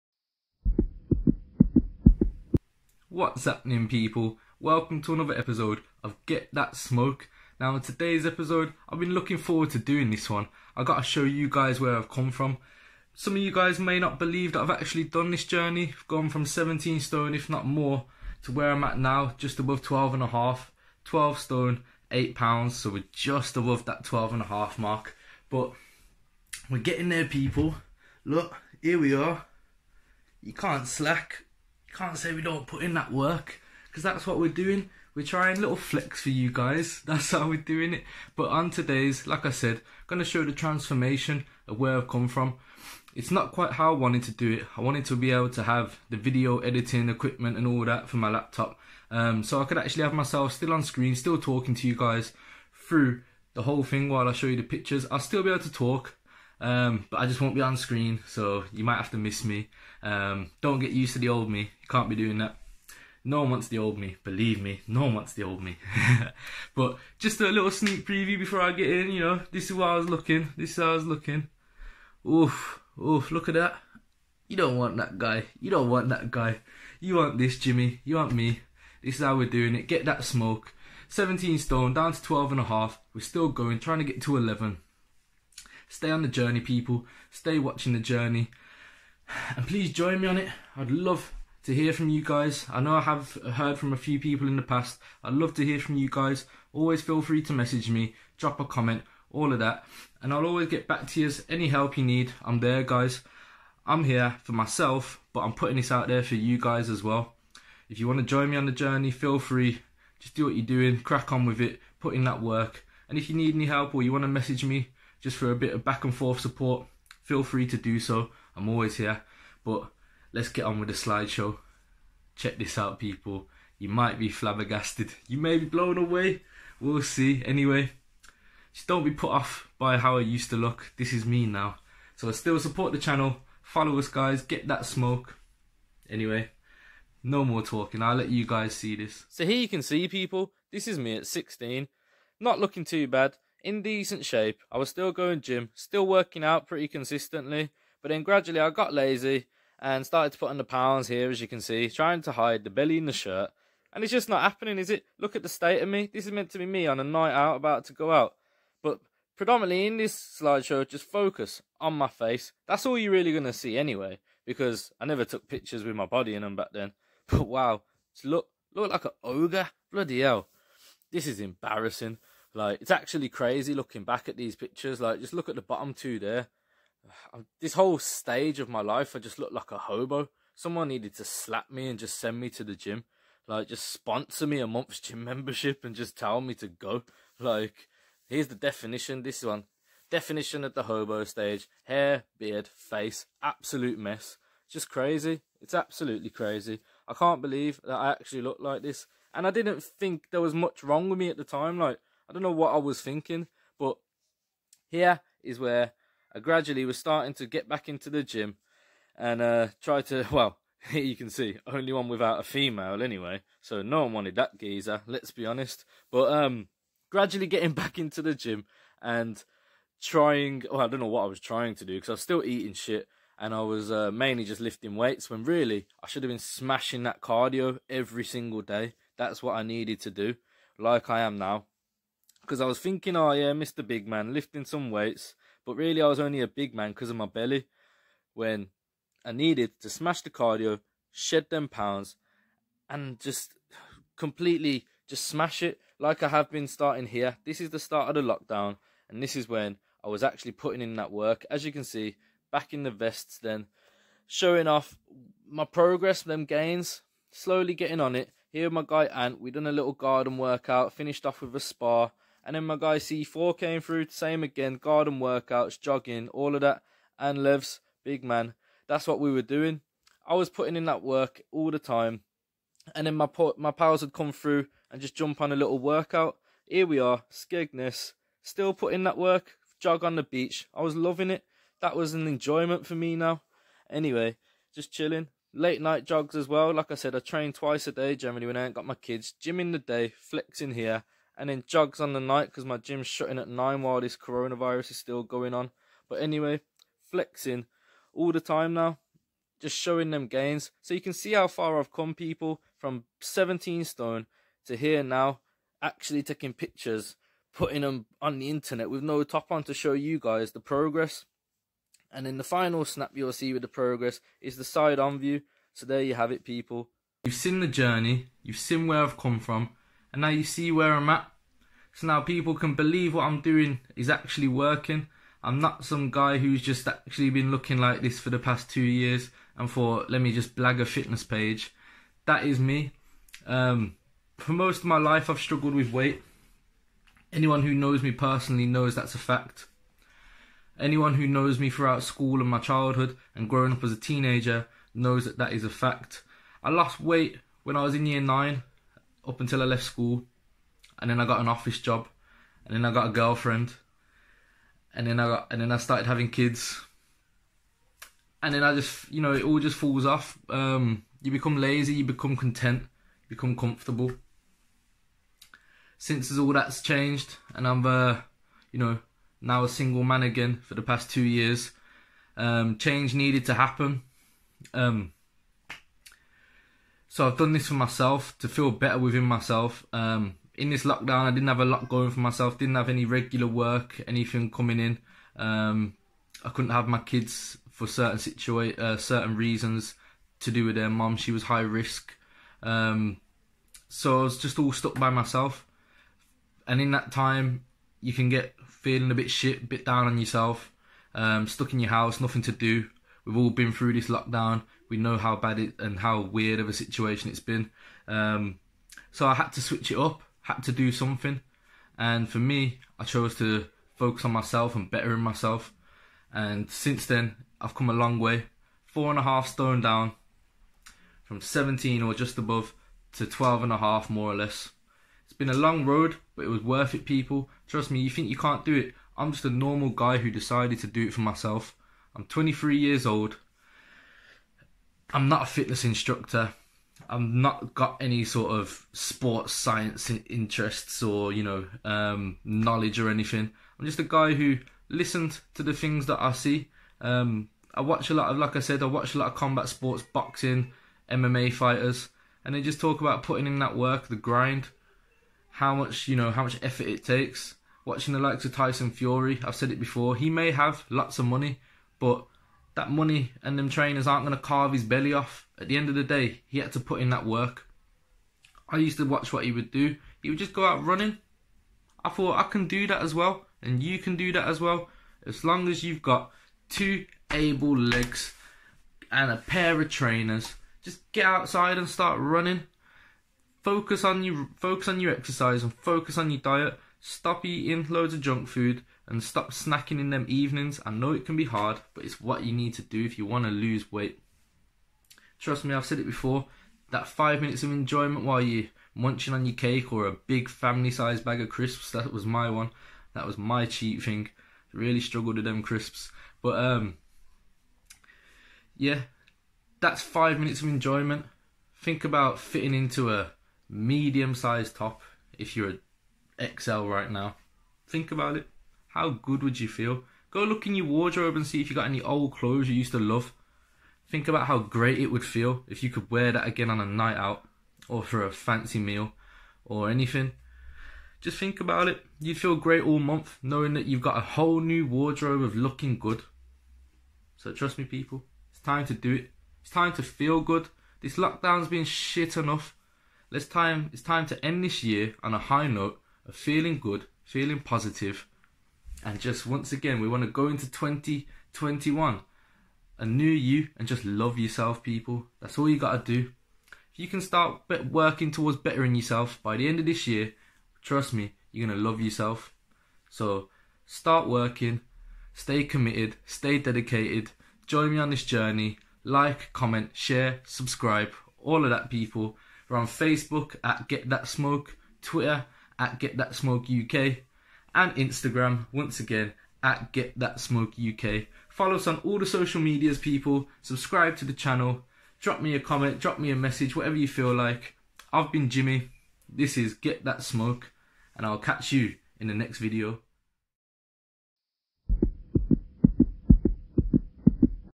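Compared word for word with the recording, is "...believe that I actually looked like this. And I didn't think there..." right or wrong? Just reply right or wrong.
right.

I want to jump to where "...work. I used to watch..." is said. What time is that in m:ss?
7:47.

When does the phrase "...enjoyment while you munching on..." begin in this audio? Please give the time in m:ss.
8:17.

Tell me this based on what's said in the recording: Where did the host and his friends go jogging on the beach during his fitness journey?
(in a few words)
Skegness.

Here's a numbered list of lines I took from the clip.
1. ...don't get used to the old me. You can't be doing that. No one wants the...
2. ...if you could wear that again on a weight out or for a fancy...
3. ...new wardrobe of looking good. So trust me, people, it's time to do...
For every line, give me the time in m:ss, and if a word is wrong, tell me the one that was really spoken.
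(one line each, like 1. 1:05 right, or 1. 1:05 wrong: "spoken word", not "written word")
1. 1:00 right
2. 8:45 wrong: "night", not "weight"
3. 8:54 right.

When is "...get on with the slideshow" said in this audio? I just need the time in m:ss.
2:00.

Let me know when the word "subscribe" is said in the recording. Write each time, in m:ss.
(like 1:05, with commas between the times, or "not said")
9:30, 9:43.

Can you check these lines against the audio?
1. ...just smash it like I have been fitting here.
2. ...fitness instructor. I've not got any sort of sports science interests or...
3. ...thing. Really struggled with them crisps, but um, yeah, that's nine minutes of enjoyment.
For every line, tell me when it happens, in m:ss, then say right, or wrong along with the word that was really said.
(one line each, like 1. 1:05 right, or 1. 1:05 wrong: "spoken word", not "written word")
1. 4:05 wrong: "starting", not "fitting"
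2. 7:15 right
3. 8:24 wrong: "five", not "nine".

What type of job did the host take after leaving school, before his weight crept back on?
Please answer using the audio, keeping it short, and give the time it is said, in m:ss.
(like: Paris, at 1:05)
Office job, at 5:51.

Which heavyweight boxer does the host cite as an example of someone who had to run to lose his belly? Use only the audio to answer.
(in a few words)
Tyson Fury.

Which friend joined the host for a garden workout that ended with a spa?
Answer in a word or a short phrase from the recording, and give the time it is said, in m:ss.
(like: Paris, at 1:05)
Ant, at 4:19.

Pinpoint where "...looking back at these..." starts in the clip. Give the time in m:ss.
2:53.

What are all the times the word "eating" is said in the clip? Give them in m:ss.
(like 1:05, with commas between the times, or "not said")
3:42, 8:07.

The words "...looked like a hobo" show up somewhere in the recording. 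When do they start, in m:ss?
2:59.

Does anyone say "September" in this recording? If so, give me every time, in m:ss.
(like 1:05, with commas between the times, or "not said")
not said.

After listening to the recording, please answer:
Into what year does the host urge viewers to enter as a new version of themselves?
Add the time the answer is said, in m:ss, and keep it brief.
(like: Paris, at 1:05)
2021, at 9:10.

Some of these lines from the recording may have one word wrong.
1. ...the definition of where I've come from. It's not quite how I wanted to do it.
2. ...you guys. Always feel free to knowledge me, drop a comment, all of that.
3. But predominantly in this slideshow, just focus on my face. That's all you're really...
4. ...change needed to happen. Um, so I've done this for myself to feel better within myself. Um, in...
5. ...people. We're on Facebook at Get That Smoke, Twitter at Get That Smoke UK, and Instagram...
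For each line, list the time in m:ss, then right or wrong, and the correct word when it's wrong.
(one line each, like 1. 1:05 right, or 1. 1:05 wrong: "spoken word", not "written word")
1. 0:40 wrong: "transformation", not "definition"
2. 1:35 wrong: "message", not "knowledge"
3. 2:38 right
4. 6:12 right
5. 9:31 right.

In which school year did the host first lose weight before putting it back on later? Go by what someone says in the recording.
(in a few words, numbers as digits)
Year 9.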